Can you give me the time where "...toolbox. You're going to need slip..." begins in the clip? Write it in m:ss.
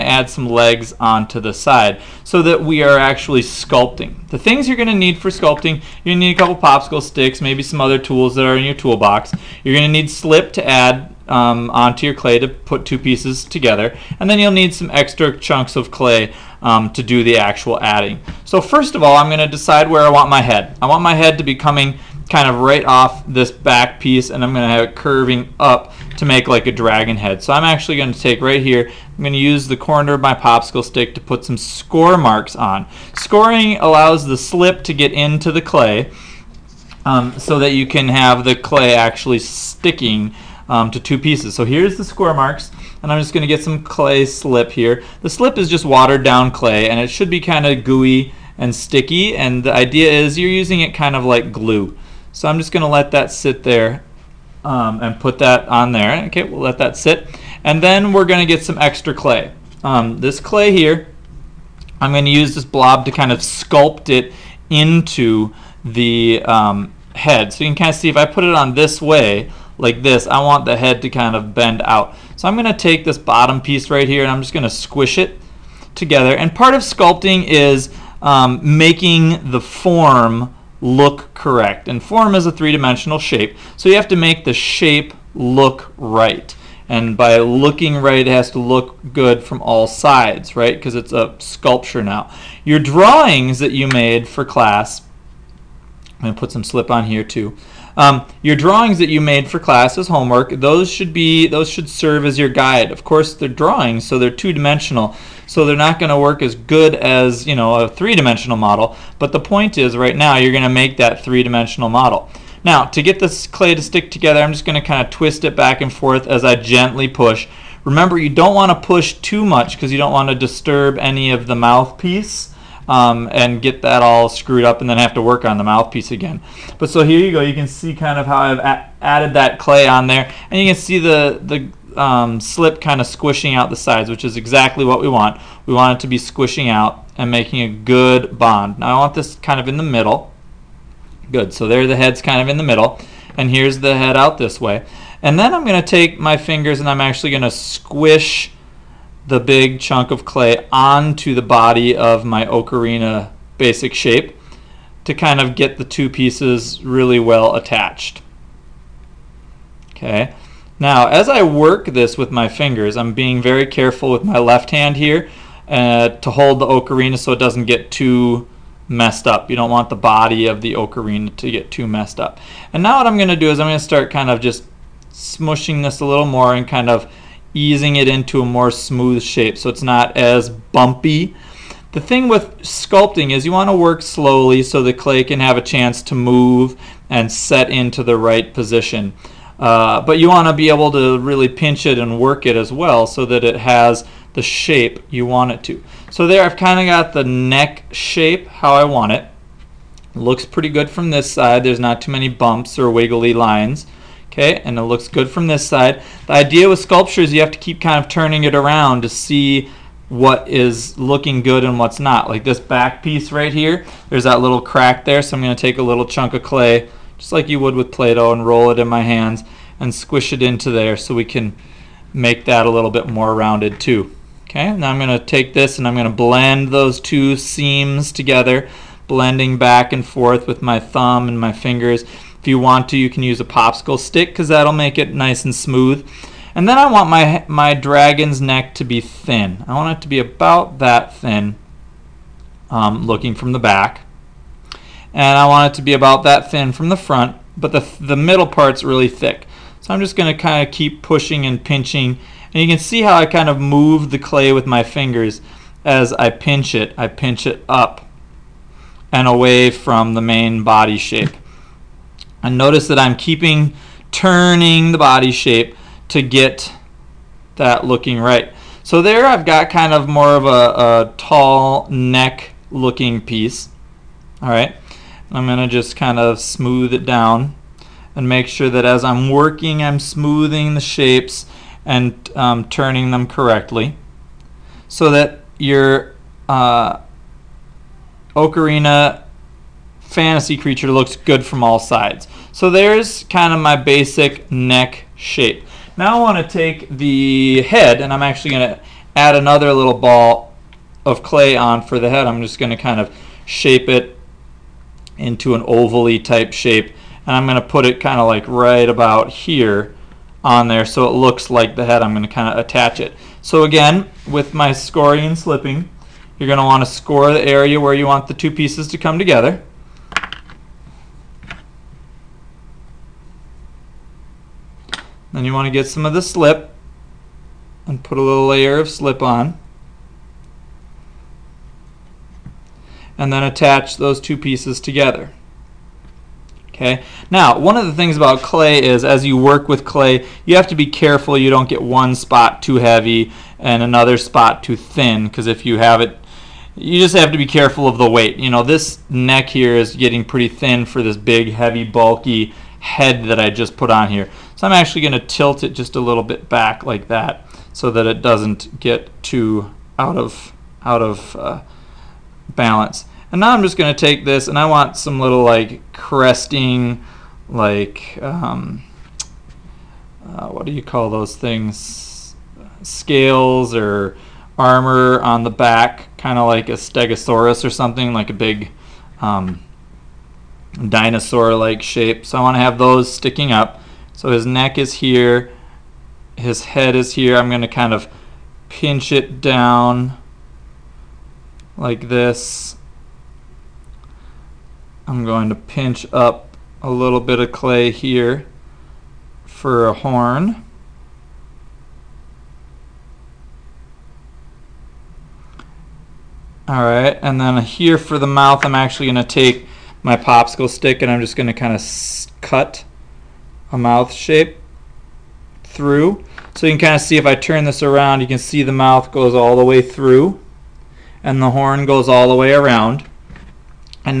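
0:08.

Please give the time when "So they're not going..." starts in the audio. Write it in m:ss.
1:45.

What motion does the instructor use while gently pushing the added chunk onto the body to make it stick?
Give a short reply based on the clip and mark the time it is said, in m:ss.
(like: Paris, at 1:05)
twist it back and forth, at 1:55.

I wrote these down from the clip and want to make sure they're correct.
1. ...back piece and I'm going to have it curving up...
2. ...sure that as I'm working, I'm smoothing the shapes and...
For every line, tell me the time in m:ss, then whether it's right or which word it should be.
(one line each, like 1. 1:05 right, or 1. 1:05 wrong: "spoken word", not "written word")
1. 0:23 right
2. 4:38 right.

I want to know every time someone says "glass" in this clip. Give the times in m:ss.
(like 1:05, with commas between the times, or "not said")
not said.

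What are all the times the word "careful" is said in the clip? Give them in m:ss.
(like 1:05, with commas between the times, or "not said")
2:43, 5:40, 5:47.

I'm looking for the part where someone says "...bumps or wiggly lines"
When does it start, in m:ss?
3:22.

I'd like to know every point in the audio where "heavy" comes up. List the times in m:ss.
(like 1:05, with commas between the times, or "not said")
5:42, 5:51.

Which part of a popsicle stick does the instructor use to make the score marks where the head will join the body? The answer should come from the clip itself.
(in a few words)
the corner.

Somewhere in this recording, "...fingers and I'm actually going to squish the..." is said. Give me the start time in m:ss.
2:26.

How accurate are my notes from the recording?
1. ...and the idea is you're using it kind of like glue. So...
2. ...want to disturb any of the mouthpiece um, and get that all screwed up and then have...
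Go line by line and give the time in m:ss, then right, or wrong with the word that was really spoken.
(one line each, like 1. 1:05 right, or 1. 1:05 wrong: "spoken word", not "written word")
1. 0:49 right
2. 2:00 right.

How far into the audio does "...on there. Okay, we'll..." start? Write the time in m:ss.
0:55.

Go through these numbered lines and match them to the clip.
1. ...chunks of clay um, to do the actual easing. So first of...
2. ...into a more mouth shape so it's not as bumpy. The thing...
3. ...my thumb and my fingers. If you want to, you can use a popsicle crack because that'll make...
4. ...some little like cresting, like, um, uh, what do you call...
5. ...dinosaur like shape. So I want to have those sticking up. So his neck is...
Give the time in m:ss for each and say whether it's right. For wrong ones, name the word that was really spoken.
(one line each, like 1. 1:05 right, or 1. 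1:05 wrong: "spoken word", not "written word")
1. 0:15 wrong: "adding", not "easing"
2. 2:58 wrong: "smooth", not "mouth"
3. 3:50 wrong: "stick", not "crack"
4. 6:04 right
5. 6:20 right.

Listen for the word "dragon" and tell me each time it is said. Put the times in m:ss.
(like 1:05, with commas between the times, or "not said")
0:26, 3:57.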